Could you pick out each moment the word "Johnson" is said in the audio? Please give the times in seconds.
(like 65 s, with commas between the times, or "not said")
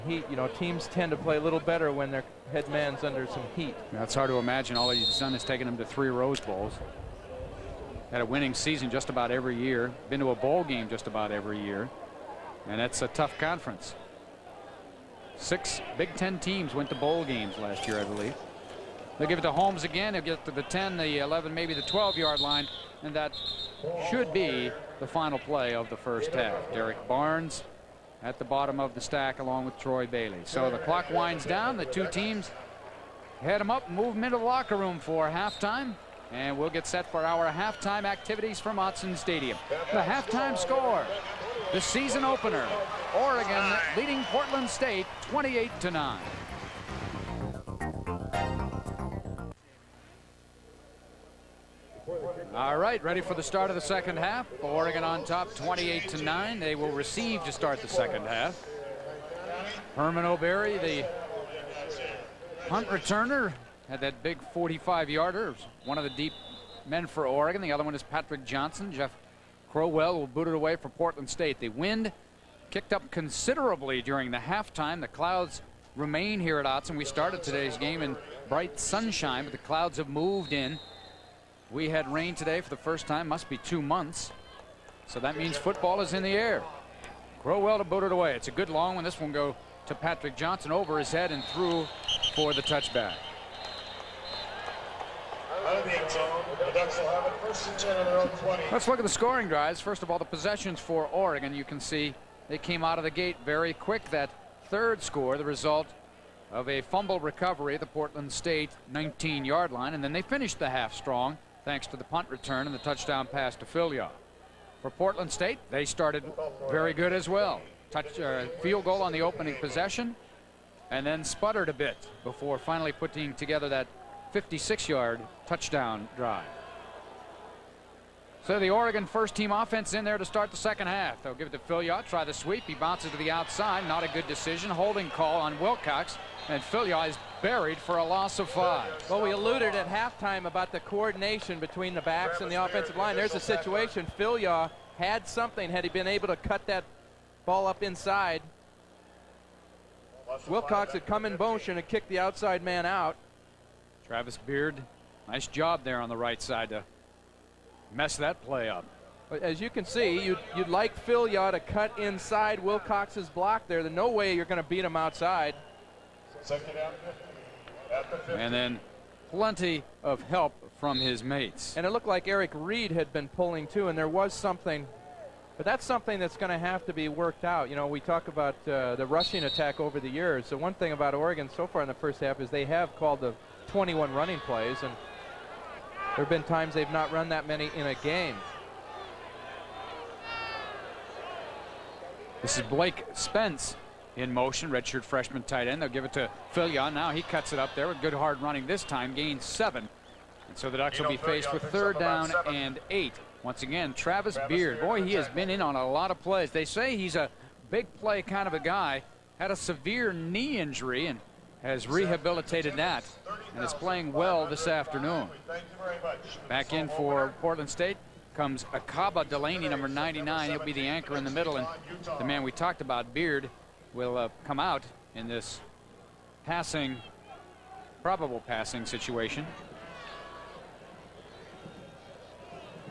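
68 s, 90 s.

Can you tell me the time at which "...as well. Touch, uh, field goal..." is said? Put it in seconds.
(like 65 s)
117 s.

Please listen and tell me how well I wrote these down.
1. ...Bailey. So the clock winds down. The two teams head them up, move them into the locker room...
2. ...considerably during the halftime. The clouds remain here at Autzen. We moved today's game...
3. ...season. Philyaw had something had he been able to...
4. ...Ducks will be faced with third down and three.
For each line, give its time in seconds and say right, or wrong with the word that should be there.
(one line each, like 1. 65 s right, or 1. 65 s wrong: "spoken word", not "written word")
1. 30 s right
2. 73 s wrong: "started", not "moved"
3. 143 s wrong: "situation", not "season"
4. 200 s wrong: "eight", not "three".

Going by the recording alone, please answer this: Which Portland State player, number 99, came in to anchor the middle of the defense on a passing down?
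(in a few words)
Akaba Delaney.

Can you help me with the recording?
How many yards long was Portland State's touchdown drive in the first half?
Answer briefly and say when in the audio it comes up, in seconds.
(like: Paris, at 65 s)
56, at 124 s.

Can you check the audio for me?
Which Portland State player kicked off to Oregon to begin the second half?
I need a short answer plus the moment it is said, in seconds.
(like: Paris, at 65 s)
Jeff Crowell, at 68 s.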